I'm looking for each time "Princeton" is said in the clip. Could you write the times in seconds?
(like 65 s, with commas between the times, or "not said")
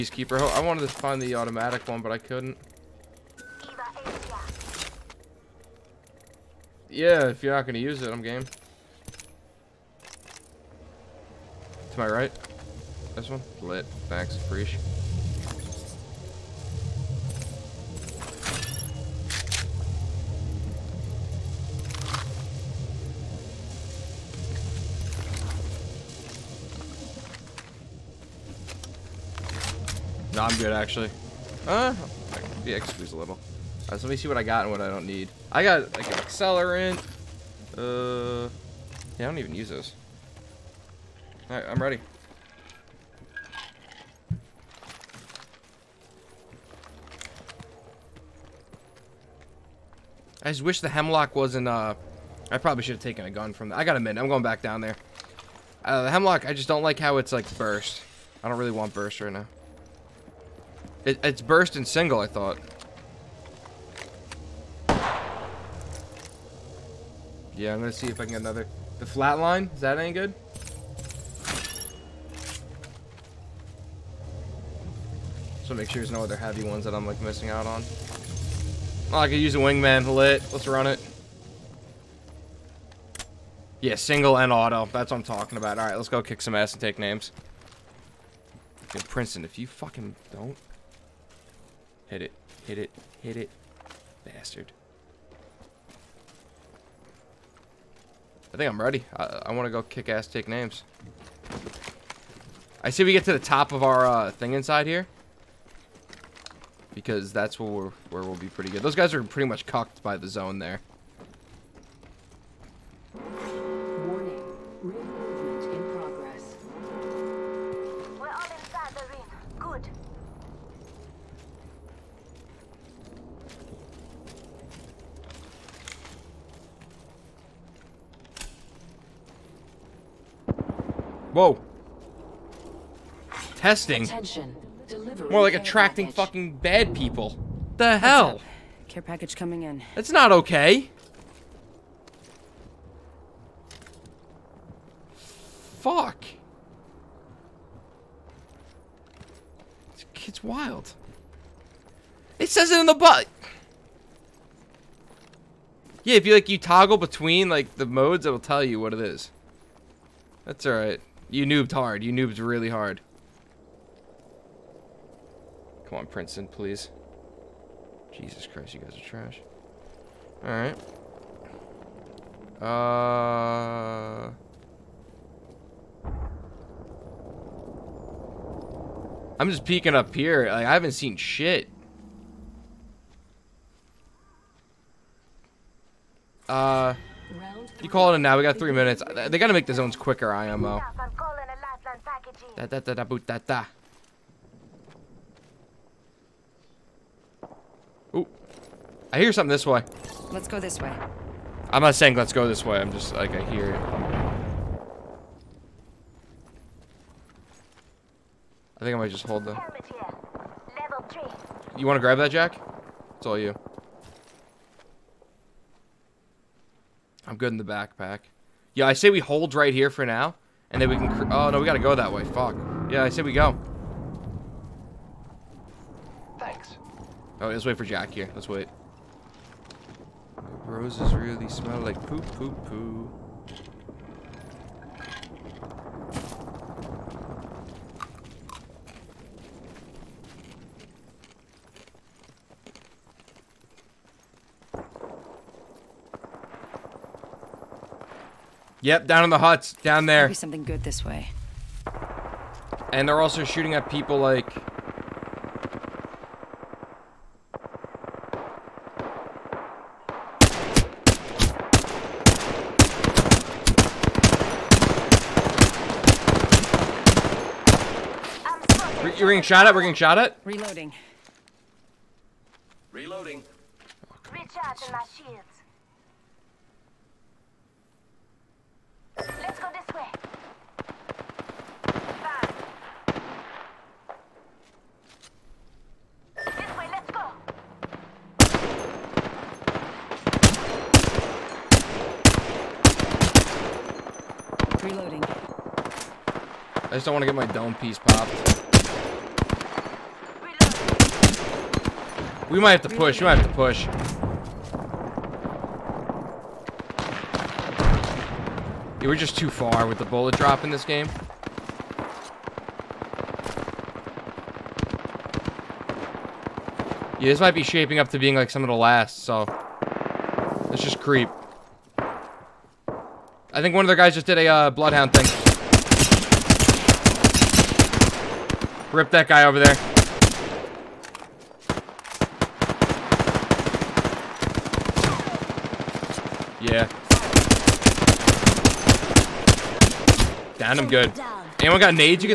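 89 s, 166 s.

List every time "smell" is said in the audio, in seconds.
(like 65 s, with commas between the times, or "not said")
231 s.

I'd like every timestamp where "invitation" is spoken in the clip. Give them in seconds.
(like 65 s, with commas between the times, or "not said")
not said.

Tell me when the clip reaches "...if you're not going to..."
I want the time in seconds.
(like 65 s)
7 s.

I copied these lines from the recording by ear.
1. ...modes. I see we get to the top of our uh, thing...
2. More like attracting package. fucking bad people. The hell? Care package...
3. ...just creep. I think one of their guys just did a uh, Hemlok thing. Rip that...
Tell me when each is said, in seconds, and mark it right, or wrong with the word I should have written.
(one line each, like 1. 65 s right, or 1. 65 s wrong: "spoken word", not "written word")
1. 100 s wrong: "names", not "modes"
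2. 135 s right
3. 320 s wrong: "Bloodhound", not "Hemlok".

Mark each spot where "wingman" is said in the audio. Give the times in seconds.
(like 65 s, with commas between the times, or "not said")
79 s.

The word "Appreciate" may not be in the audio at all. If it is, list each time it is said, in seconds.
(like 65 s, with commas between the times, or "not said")
14 s.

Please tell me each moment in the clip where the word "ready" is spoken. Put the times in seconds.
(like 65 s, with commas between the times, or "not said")
41 s, 98 s.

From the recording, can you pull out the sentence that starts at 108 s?
Those guys are pretty much cocked by the zone there.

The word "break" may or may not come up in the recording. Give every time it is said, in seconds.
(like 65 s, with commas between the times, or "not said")
not said.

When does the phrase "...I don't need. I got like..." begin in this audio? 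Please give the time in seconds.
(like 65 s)
34 s.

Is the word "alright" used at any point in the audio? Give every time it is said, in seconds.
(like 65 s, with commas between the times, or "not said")
41 s, 160 s, 170 s.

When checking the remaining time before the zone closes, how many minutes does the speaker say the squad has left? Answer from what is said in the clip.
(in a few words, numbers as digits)
3.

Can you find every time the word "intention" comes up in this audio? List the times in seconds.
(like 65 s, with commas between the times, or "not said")
not said.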